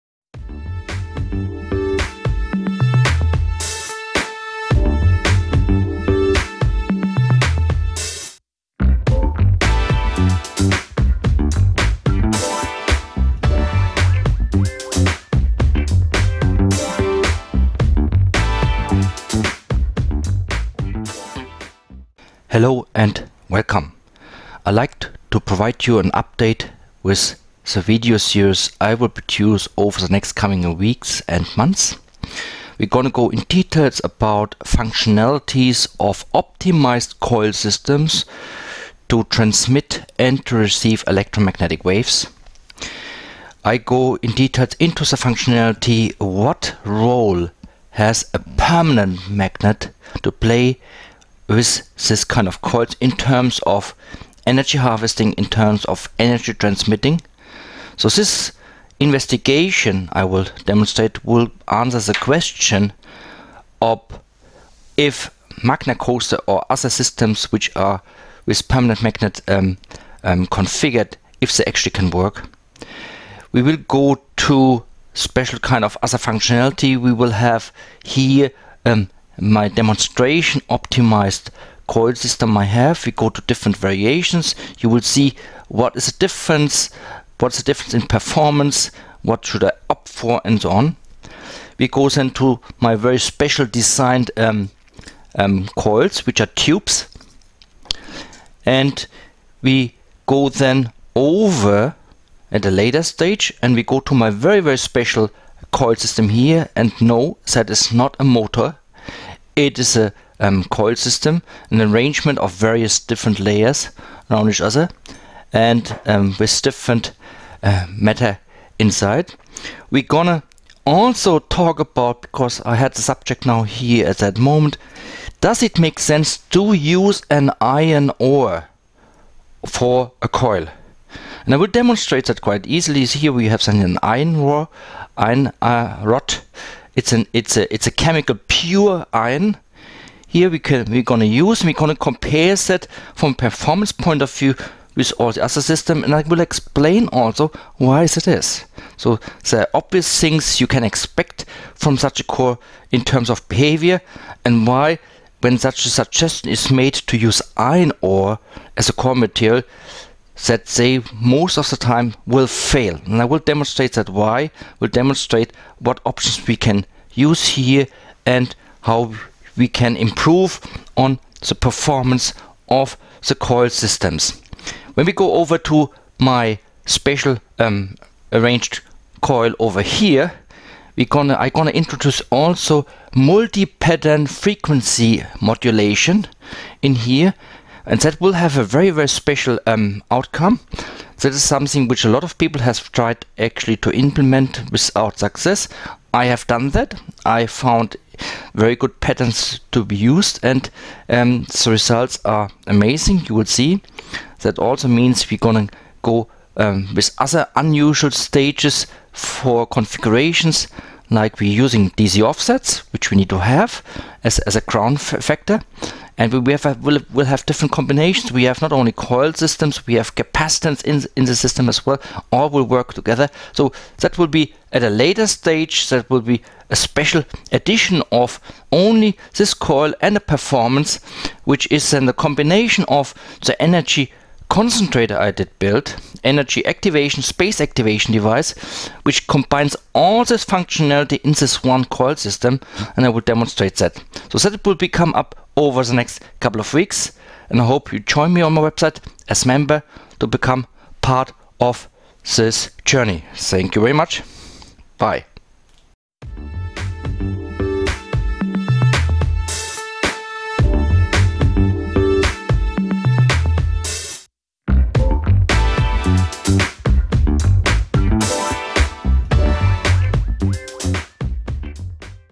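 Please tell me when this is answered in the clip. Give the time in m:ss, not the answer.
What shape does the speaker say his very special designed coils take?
1:36.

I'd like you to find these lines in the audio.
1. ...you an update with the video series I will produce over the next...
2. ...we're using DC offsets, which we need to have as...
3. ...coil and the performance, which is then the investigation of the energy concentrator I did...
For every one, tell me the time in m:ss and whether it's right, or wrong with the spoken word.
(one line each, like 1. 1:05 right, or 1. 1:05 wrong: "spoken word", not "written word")
1. 0:25 right
2. 3:31 right
3. 3:49 wrong: "combination", not "investigation".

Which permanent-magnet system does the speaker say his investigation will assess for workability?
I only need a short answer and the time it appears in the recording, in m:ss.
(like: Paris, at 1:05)
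Magnacoaster, at 1:05.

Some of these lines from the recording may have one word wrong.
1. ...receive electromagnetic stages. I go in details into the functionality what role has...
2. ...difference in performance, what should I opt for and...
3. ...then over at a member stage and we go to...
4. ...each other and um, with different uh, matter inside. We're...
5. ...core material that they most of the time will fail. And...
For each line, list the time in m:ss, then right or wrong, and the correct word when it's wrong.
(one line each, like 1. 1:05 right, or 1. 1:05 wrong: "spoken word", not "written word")
1. 0:40 wrong: "waves", not "stages"
2. 1:27 right
3. 1:40 wrong: "later", not "member"
4. 1:54 right
5. 2:38 right.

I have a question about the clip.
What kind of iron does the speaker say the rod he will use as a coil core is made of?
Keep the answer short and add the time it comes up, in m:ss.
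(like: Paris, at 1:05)
chemical pure iron, at 2:17.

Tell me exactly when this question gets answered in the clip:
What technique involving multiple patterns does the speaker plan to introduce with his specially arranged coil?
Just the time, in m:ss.
3:03.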